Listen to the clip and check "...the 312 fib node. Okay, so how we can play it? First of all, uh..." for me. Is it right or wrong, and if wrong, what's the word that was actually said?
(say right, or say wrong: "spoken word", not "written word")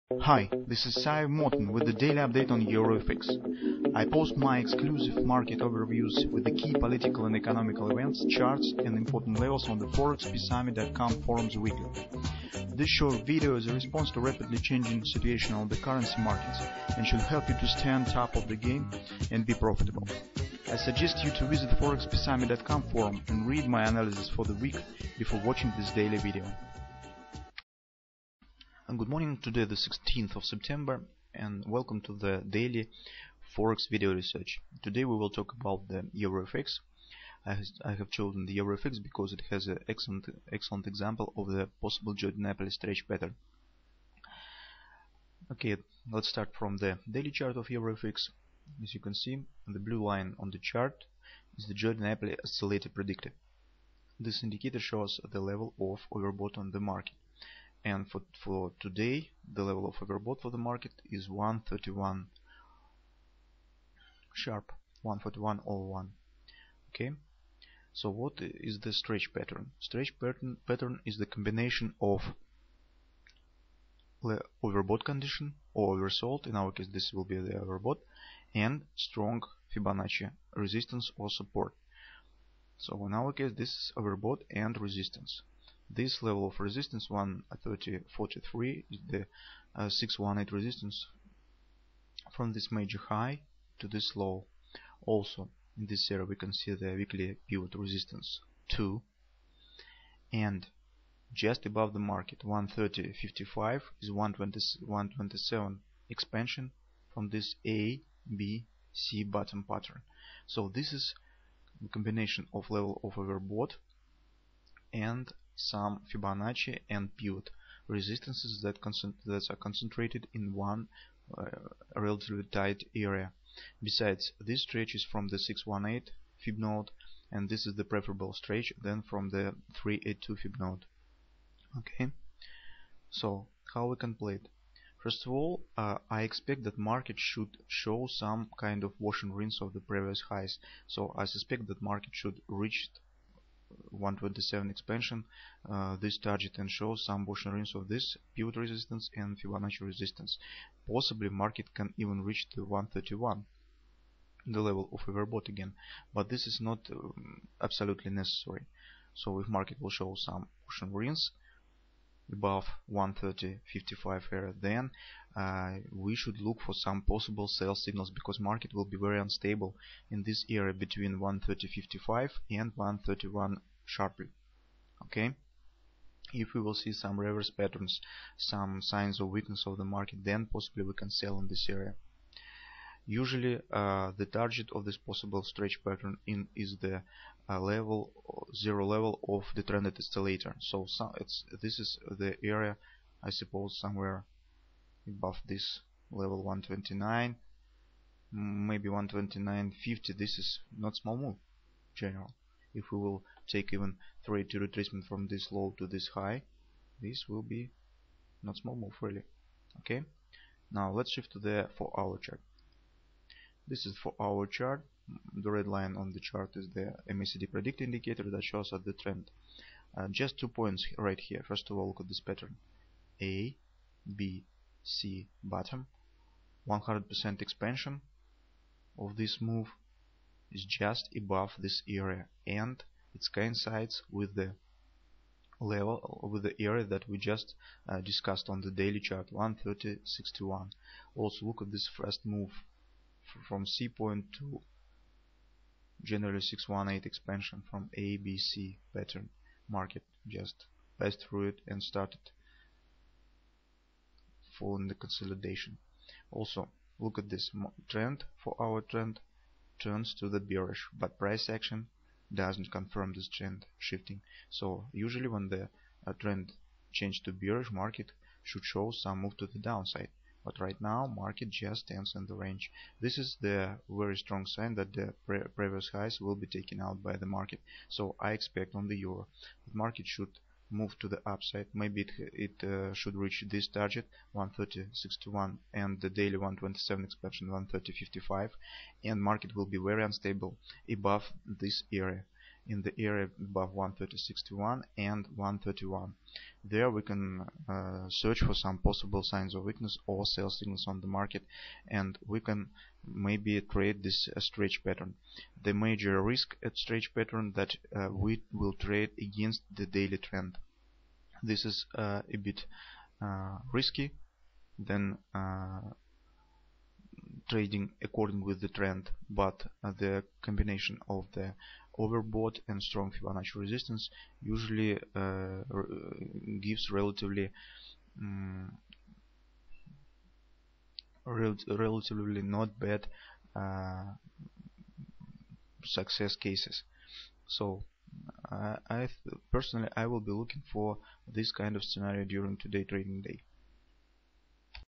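wrong: "382", not "312".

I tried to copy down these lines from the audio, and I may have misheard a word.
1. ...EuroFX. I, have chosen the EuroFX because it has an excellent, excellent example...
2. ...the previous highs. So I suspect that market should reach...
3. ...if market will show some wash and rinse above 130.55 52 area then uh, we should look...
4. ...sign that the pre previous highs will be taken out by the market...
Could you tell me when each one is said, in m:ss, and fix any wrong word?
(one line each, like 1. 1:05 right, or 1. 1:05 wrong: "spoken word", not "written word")
1. 0:36 right
2. 2:19 right
3. 2:39 wrong: "55", not "52"
4. 4:34 right.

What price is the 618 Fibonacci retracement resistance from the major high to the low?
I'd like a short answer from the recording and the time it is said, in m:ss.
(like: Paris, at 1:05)
130.43, at 1:27.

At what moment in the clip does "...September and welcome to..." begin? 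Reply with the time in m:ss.
0:30.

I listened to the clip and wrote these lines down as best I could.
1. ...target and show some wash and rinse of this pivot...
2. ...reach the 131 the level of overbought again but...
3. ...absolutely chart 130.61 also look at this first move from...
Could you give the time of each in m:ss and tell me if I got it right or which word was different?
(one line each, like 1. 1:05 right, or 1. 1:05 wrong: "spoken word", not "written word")
1. 2:26 right
2. 2:32 right
3. 3:58 wrong: "daily", not "absolutely".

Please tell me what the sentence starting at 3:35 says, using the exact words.
The red line on the chart is the MACD predict indicator that shows us the trend.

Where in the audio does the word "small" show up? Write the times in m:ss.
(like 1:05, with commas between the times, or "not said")
3:20, 3:28.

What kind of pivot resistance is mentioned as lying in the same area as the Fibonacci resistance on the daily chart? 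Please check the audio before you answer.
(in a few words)
weekly pivot resistance 2.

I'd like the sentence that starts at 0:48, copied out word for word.
As you can see, the blue line on the chart is the Joe DiNapoli's oscillator predictor.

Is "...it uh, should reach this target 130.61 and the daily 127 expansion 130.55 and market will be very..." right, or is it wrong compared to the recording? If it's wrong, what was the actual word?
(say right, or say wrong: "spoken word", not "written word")
right.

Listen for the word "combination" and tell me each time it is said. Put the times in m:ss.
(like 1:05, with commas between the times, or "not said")
1:11, 1:51, 5:20.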